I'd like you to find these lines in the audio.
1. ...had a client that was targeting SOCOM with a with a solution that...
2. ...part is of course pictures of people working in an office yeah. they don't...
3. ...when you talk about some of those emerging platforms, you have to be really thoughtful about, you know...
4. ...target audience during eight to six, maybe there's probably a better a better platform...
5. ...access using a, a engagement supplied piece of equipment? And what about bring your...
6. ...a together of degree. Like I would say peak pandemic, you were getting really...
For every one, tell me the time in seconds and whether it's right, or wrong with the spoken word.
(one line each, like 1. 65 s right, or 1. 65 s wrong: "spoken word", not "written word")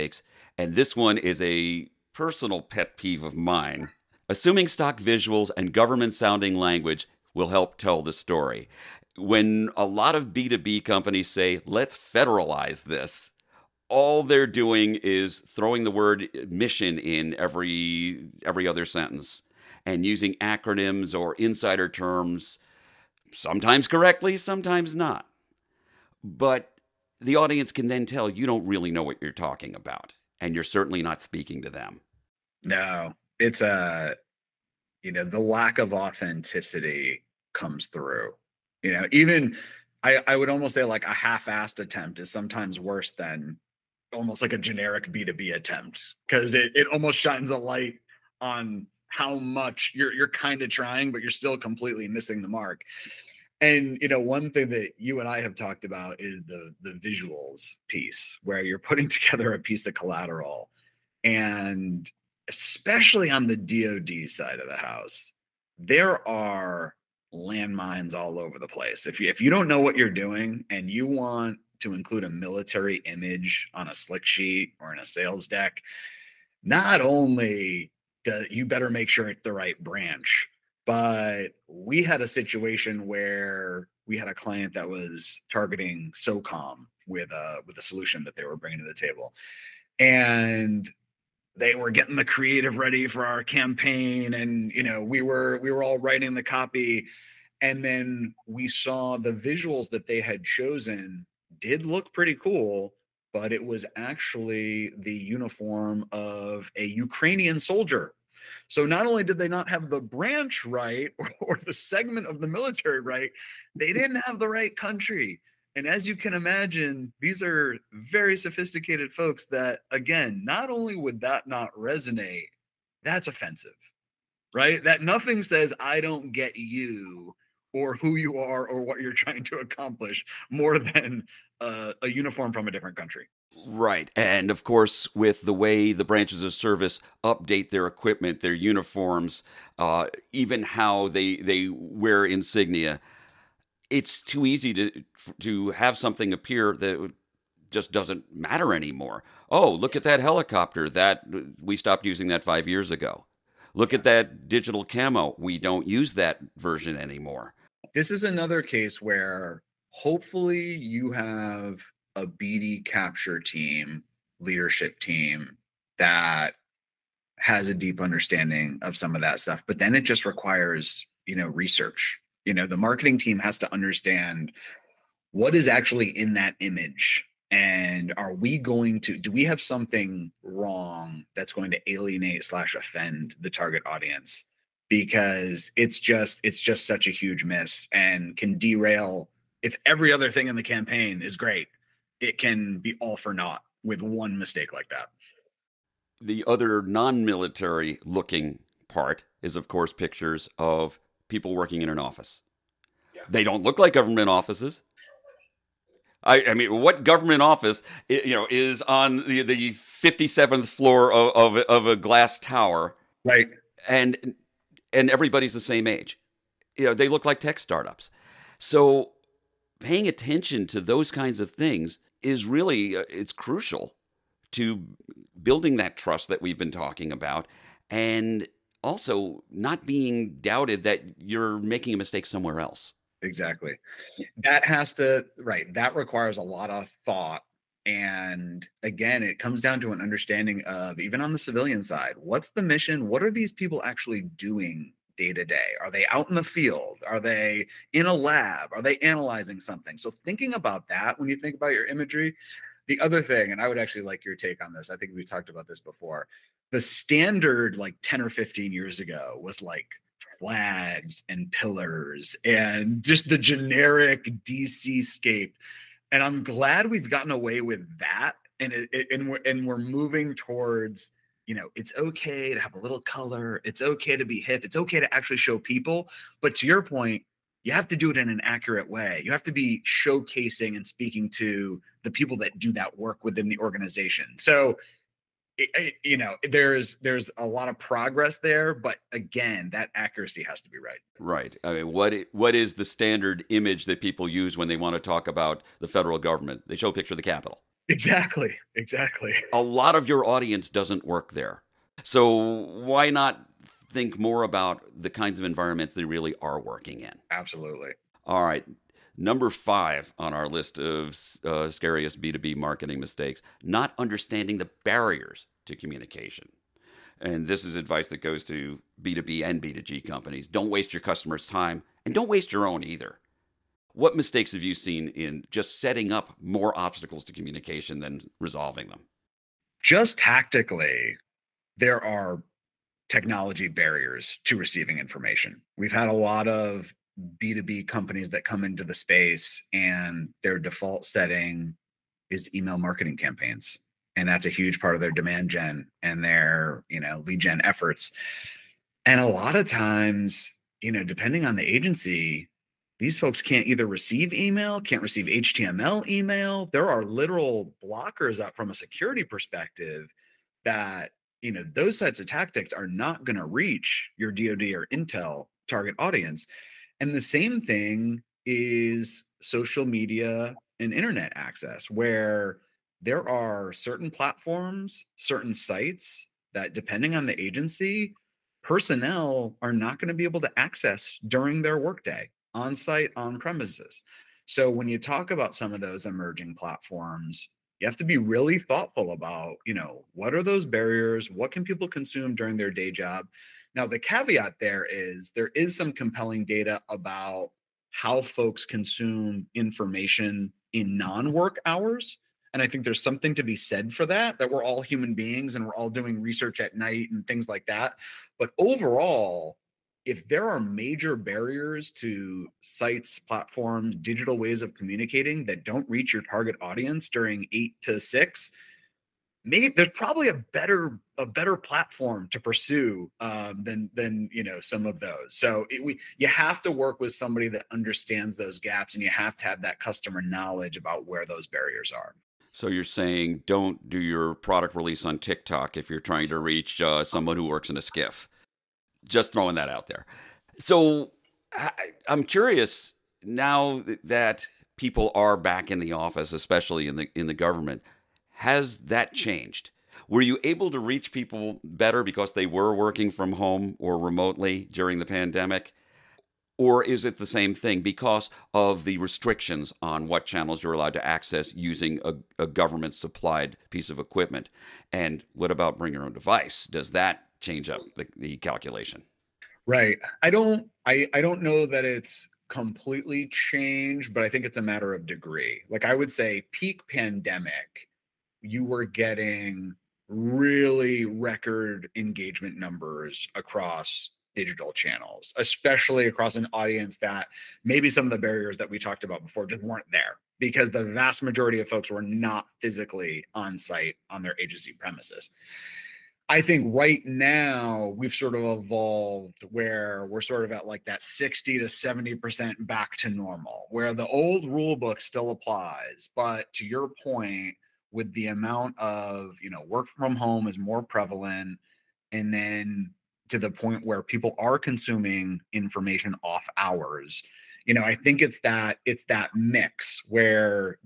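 1. 84 s right
2. 198 s right
3. 384 s right
4. 416 s right
5. 461 s wrong: "government", not "engagement"
6. 474 s wrong: "matter", not "together".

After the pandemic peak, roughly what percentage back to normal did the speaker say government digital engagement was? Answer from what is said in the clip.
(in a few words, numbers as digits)
60 to 70%.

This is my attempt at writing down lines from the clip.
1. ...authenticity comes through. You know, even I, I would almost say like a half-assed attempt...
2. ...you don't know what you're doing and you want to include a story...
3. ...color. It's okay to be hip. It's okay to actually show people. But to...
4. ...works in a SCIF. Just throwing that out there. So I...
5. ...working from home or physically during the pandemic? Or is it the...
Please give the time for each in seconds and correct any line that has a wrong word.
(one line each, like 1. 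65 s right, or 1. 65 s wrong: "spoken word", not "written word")
1. 35 s right
2. 69 s wrong: "military", not "story"
3. 273 s right
4. 437 s right
5. 452 s wrong: "remotely", not "physically".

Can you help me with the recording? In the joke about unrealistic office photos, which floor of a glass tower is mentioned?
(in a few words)
57th floor.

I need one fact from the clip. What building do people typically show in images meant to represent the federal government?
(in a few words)
The Capitol.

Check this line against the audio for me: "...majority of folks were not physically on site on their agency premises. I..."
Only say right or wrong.
right.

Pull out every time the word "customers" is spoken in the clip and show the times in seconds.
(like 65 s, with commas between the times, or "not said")
321 s, 429 s.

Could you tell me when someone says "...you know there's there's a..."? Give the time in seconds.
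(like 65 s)
286 s.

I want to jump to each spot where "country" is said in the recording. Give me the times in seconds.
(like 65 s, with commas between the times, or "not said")
114 s, 132 s.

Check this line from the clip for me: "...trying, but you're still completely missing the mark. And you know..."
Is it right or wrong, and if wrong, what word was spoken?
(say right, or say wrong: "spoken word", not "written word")
right.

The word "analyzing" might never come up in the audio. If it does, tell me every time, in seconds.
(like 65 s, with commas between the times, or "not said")
248 s.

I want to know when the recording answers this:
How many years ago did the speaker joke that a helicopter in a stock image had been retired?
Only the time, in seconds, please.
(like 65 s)
152 s.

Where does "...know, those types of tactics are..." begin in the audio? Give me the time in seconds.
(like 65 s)
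361 s.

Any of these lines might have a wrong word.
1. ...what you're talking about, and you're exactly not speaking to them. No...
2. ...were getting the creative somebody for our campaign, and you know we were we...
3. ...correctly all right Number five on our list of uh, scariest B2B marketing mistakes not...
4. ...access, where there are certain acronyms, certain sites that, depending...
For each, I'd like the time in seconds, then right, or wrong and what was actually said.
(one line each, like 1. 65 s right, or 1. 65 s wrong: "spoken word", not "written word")
1. 29 s wrong: "certainly", not "exactly"
2. 91 s wrong: "ready", not "somebody"
3. 307 s wrong: "absolutely", not "correctly"
4. 371 s wrong: "platforms", not "acronyms".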